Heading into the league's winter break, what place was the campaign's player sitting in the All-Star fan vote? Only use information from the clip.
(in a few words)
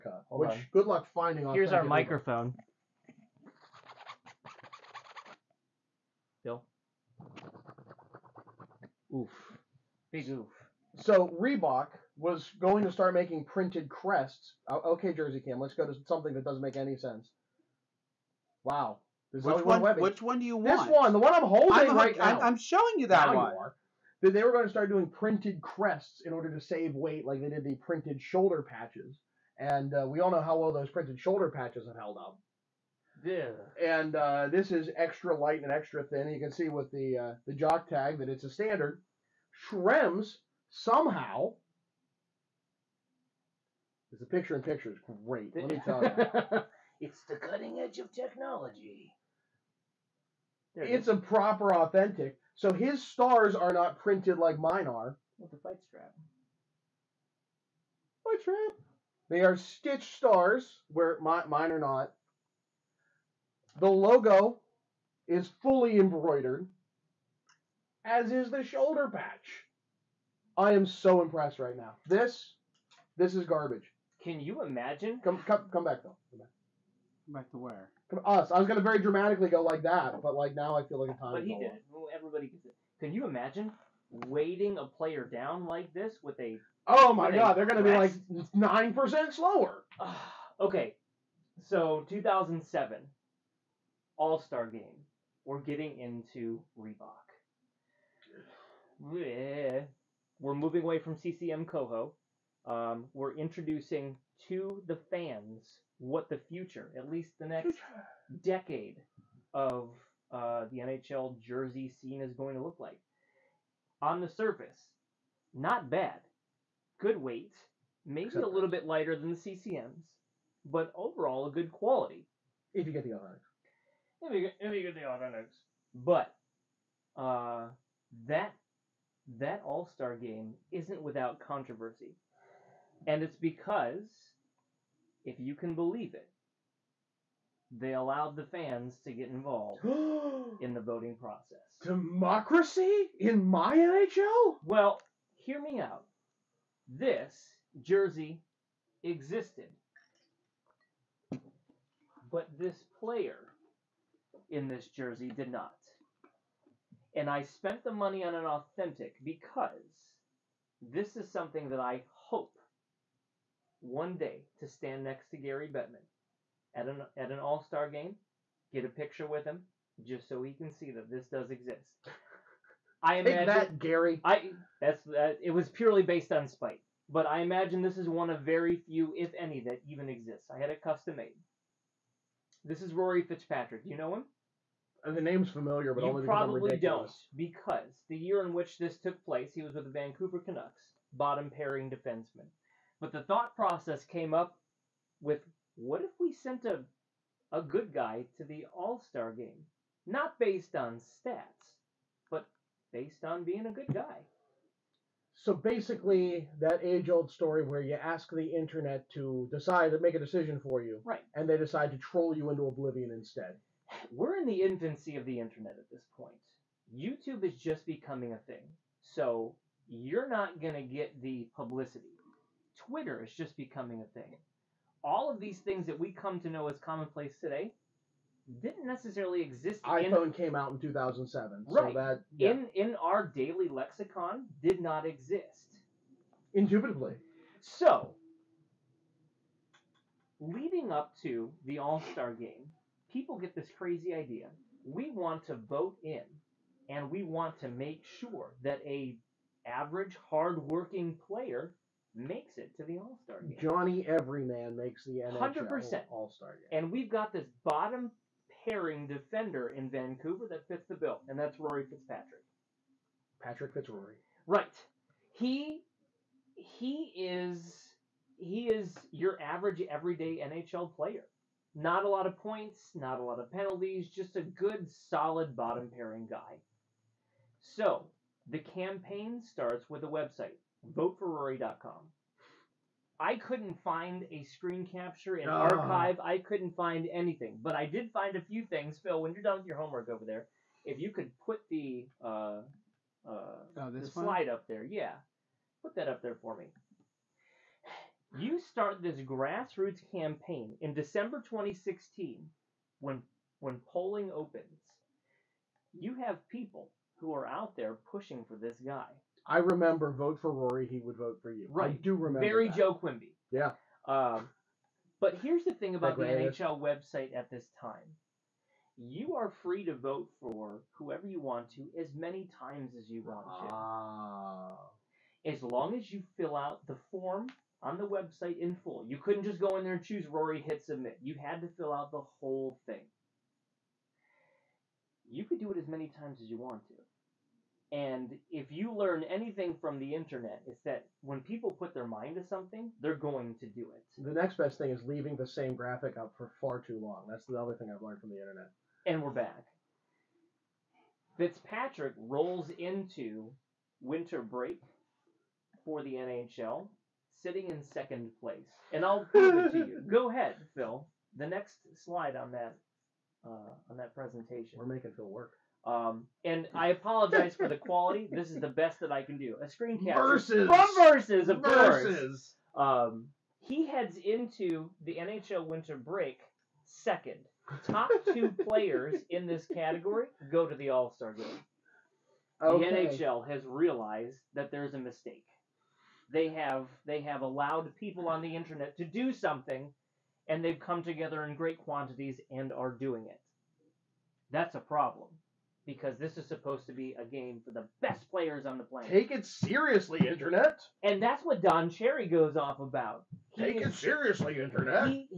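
Second place.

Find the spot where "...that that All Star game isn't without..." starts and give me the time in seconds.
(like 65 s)
128 s.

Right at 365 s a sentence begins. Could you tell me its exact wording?
Um, and I apologize for the quality.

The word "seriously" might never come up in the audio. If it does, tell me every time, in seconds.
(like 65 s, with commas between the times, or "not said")
399 s, 403 s.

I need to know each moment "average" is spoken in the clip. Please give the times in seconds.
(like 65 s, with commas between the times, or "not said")
249 s, 269 s.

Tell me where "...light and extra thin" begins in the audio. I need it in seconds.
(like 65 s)
35 s.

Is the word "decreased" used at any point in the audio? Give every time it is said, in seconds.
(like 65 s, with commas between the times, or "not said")
not said.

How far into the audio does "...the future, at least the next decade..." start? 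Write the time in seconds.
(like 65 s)
106 s.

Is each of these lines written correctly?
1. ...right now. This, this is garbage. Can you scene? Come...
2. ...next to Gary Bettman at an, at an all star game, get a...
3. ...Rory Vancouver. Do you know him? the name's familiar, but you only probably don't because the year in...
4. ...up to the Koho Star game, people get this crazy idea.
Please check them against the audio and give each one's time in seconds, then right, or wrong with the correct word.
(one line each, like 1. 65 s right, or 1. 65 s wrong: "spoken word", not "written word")
1. 71 s wrong: "imagine", not "scene"
2. 165 s right
3. 182 s wrong: "Fitzpatrick", not "Vancouver"
4. 240 s wrong: "All", not "Koho".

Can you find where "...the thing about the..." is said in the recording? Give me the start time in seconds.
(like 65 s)
315 s.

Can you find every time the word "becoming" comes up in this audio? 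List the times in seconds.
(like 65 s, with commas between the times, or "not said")
217 s, 223 s.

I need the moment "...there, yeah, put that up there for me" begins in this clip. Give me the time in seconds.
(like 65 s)
294 s.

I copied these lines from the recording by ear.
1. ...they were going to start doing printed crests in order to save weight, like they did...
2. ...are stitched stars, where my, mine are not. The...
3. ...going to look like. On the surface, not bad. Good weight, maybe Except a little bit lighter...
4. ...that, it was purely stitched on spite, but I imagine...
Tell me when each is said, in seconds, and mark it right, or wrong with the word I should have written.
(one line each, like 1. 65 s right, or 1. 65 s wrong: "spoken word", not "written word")
1. 24 s right
2. 59 s right
3. 112 s right
4. 175 s wrong: "based", not "stitched".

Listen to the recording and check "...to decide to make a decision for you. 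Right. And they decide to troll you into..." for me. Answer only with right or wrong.
right.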